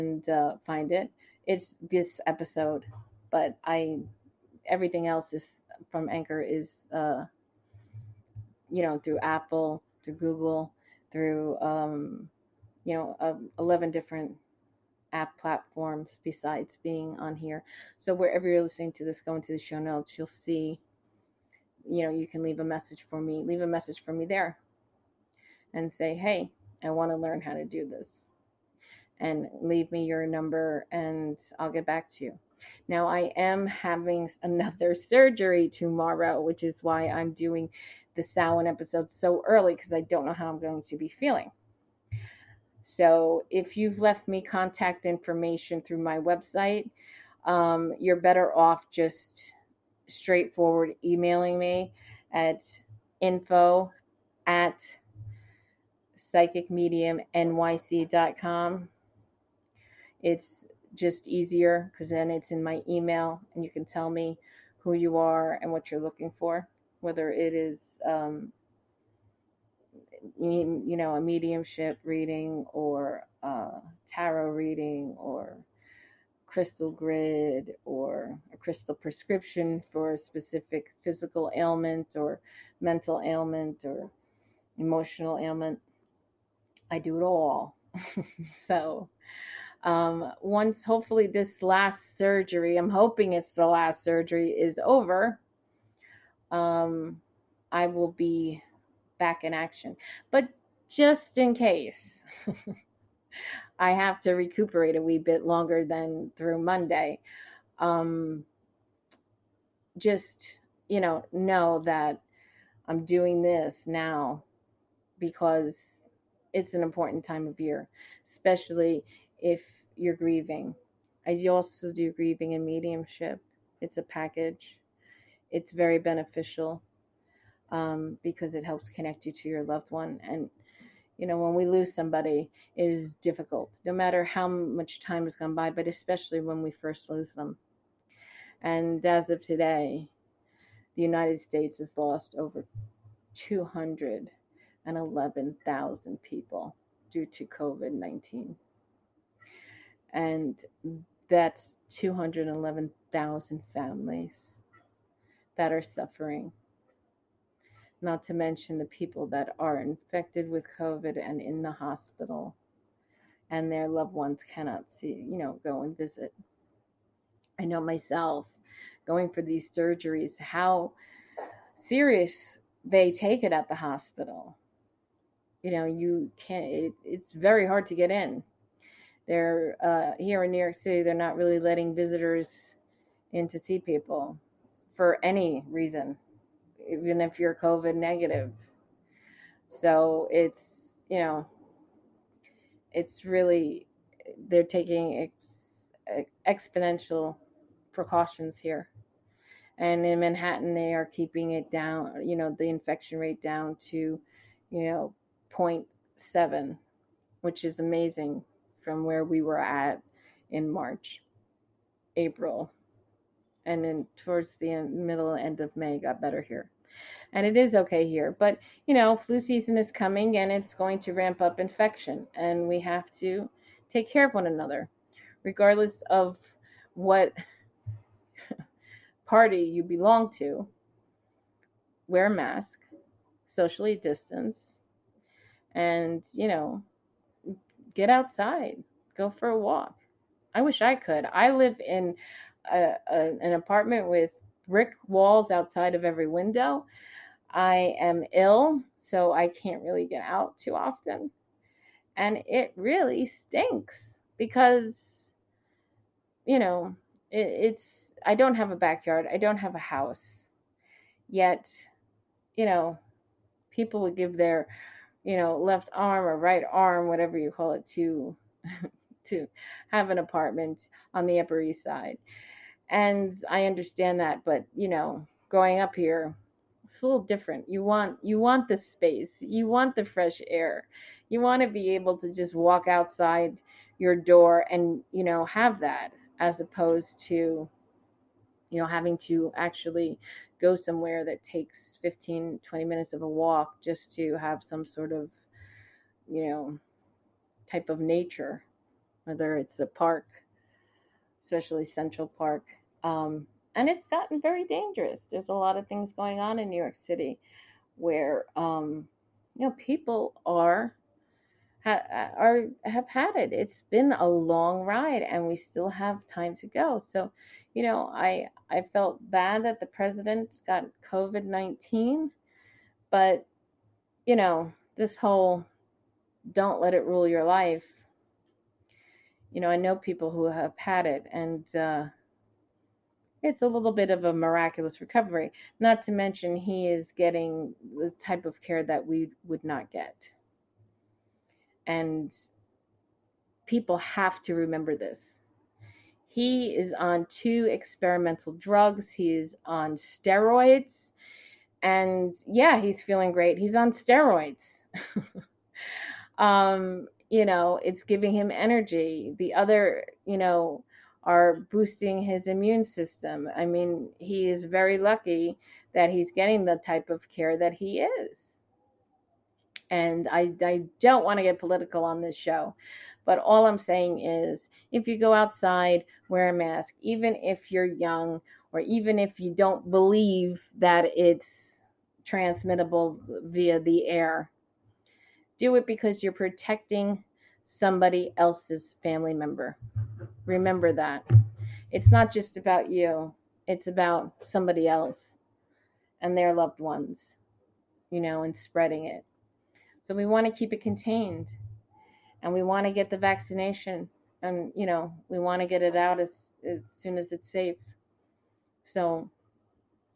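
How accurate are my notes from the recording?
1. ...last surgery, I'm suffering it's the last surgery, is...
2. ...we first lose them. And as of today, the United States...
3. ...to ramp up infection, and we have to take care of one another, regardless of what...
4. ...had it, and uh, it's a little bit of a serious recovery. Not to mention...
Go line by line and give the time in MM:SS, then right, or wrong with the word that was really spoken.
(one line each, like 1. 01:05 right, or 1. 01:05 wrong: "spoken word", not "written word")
1. 01:31 wrong: "hoping", not "suffering"
2. 02:16 right
3. 03:41 right
4. 05:30 wrong: "miraculous", not "serious".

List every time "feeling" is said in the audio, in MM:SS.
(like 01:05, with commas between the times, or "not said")
00:41, 05:53.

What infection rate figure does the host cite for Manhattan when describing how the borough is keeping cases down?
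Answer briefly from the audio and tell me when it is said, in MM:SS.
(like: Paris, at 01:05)
0.7, at 03:25.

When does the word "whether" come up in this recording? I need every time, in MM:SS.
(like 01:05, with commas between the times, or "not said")
01:07, 04:59.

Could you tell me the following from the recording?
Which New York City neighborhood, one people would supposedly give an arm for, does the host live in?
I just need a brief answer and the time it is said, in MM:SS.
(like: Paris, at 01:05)
Upper East Side, at 04:31.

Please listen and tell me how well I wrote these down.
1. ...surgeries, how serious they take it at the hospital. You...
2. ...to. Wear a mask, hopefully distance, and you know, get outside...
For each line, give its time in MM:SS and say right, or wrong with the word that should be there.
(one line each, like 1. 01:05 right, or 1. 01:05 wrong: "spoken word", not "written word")
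1. 02:49 right
2. 03:50 wrong: "socially", not "hopefully".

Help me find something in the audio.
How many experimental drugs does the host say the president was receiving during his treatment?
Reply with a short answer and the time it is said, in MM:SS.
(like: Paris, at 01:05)
2, at 05:47.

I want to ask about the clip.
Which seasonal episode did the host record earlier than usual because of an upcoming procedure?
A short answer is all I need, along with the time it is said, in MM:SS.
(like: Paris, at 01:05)
Samhain, at 00:38.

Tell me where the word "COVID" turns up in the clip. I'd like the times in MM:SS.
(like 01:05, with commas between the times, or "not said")
02:27, 02:40, 03:07, 05:21.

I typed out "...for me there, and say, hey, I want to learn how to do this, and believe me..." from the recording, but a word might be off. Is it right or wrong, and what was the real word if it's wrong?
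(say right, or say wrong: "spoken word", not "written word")
wrong: "leave", not "believe".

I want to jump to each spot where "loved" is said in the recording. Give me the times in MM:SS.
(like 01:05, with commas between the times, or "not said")
02:09, 02:43, 06:36.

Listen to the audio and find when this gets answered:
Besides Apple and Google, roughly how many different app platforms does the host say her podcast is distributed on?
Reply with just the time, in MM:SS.
00:13.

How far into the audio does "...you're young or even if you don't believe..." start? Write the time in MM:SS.
06:17.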